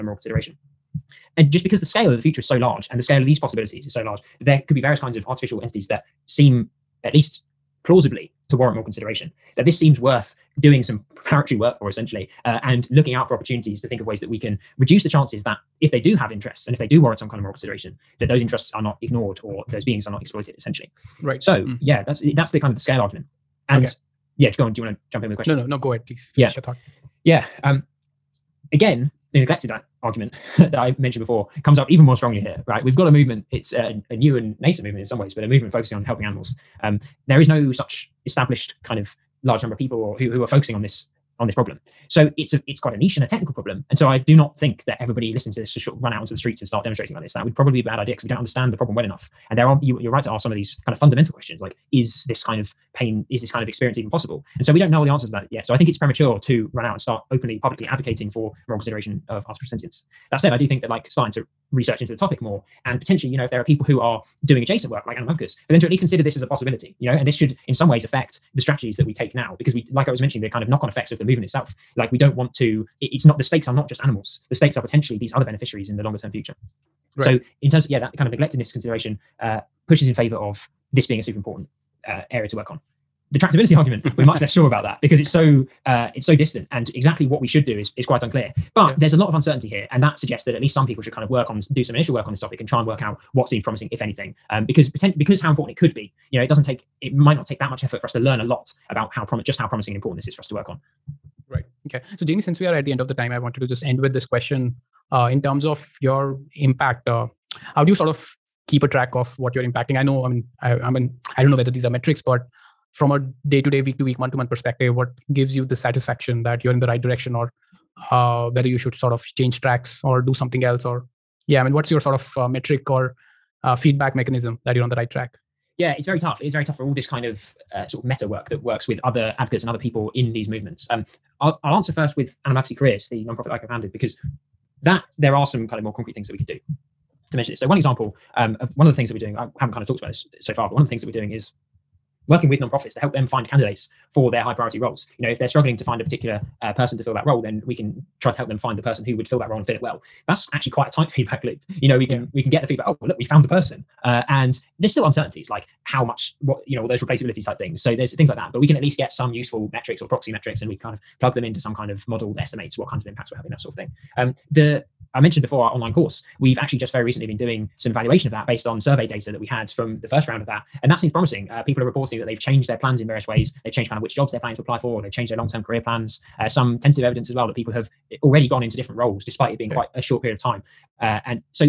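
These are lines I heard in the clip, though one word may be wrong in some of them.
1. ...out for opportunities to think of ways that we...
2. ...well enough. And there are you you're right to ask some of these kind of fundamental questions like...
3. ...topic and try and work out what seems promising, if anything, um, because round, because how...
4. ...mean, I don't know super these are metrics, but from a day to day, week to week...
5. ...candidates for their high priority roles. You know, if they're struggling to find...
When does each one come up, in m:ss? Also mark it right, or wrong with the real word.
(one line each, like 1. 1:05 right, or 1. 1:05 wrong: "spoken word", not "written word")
1. 0:13 right
2. 0:48 right
3. 1:32 wrong: "pretend", not "round"
4. 1:50 wrong: "whether", not "super"
5. 2:23 right.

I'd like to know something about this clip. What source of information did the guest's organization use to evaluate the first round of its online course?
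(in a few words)
Survey data.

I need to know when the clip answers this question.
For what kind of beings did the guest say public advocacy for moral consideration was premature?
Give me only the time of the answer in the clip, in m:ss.
0:59.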